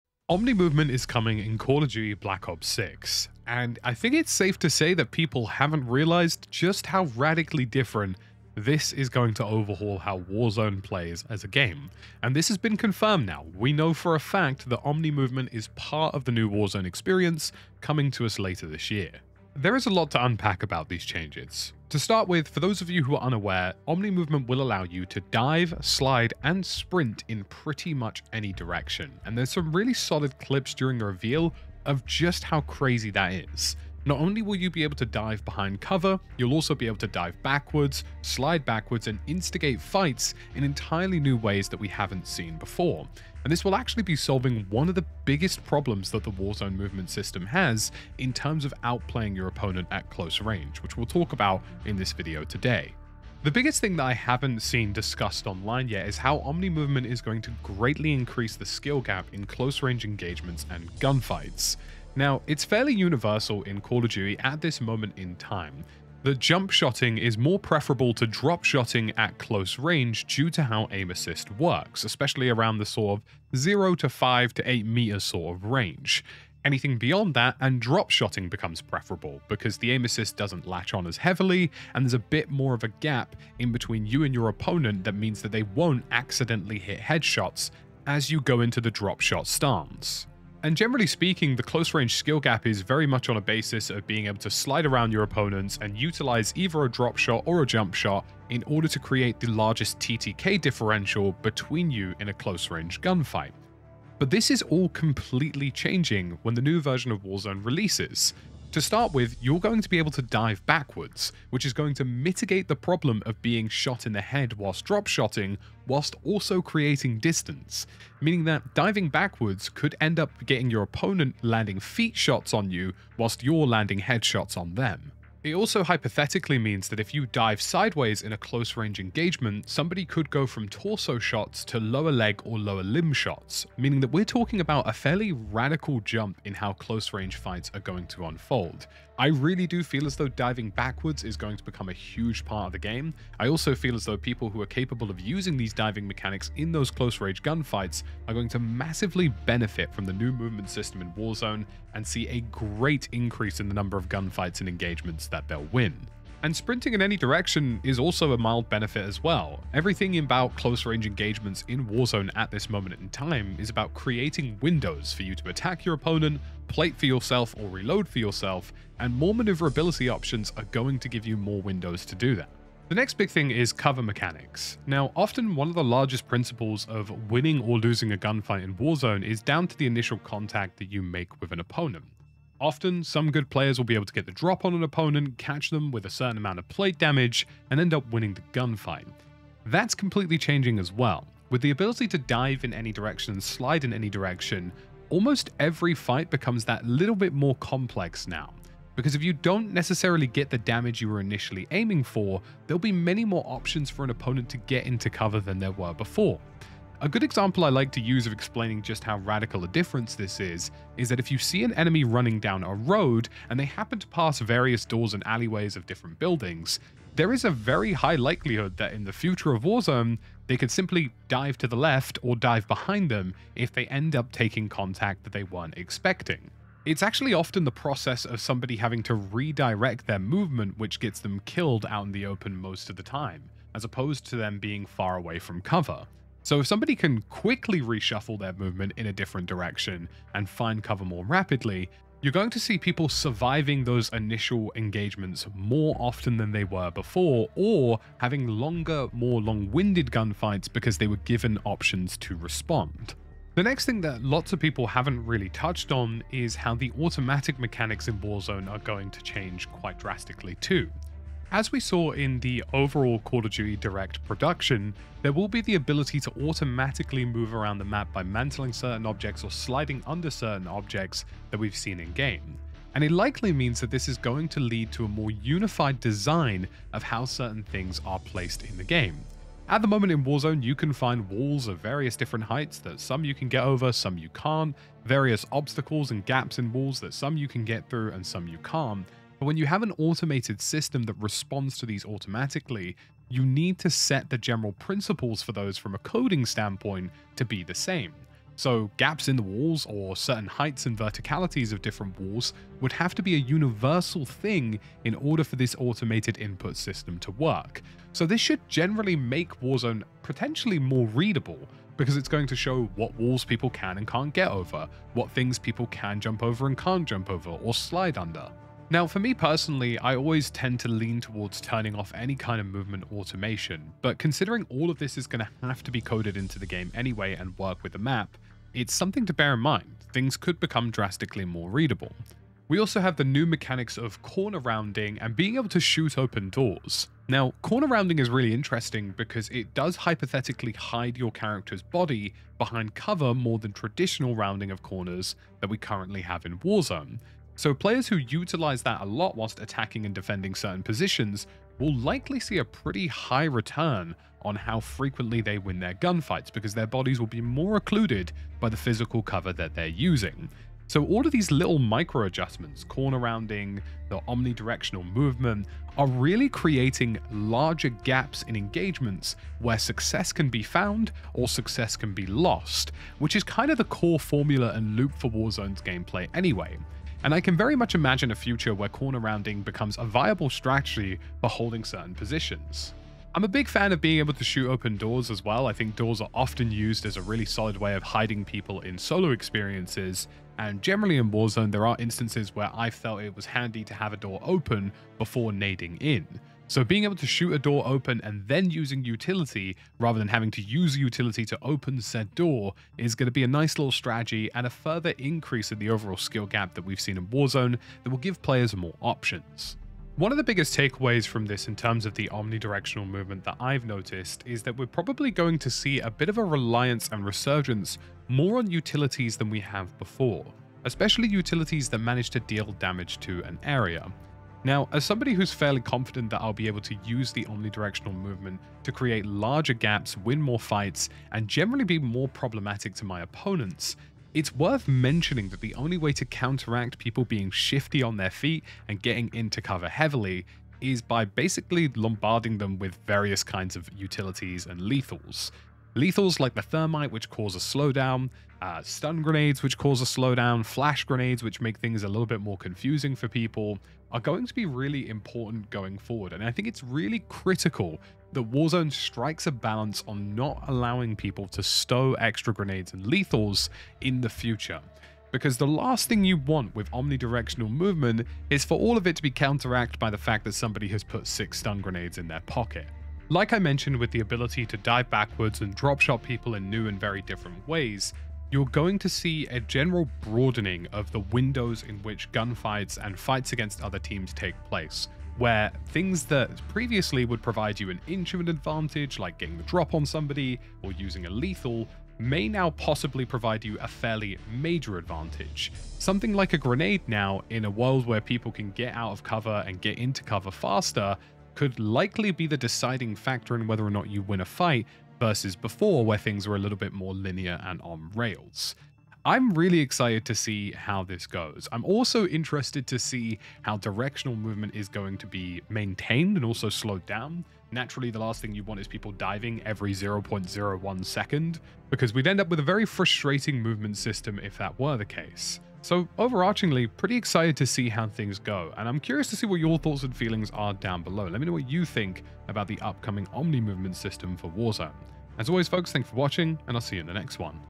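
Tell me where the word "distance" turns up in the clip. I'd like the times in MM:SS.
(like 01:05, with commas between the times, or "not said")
01:57.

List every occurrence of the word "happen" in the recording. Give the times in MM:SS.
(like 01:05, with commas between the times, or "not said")
03:33.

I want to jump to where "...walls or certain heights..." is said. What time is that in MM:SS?
04:59.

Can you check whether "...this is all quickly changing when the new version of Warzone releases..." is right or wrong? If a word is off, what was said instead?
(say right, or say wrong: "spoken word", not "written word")
wrong: "completely", not "quickly".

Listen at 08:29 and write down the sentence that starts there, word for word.
I'm really excited to see how this goes.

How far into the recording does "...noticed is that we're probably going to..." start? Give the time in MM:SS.
06:53.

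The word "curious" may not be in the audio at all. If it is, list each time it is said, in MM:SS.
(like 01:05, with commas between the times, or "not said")
08:48.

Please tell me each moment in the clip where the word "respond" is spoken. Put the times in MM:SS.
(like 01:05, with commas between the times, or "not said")
04:12, 04:51.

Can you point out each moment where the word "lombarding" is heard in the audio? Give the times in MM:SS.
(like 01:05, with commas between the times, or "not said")
07:21.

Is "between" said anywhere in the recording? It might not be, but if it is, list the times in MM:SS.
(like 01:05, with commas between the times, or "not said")
01:23, 01:41.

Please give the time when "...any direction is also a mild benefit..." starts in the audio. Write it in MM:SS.
02:37.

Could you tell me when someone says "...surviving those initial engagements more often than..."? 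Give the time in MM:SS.
04:03.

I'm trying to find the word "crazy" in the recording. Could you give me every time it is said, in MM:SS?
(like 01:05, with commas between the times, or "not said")
00:32.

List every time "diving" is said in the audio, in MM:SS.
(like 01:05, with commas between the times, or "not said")
01:58, 02:20, 02:25, 08:39.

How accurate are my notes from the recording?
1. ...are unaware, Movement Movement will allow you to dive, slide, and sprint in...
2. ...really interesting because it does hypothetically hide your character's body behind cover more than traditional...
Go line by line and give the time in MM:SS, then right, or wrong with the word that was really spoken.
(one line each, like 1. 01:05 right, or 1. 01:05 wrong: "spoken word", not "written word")
1. 00:23 wrong: "Omni", not "Movement"
2. 05:38 right.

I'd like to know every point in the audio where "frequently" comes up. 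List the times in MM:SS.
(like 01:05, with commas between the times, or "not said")
05:54.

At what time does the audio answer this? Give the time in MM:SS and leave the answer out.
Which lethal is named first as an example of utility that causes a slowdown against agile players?
07:26.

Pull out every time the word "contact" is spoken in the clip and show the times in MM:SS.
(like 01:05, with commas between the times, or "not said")
03:00, 03:44.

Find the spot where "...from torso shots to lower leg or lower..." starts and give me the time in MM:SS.
02:10.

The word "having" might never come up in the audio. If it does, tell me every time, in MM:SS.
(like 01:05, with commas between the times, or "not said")
03:48, 04:08, 06:40.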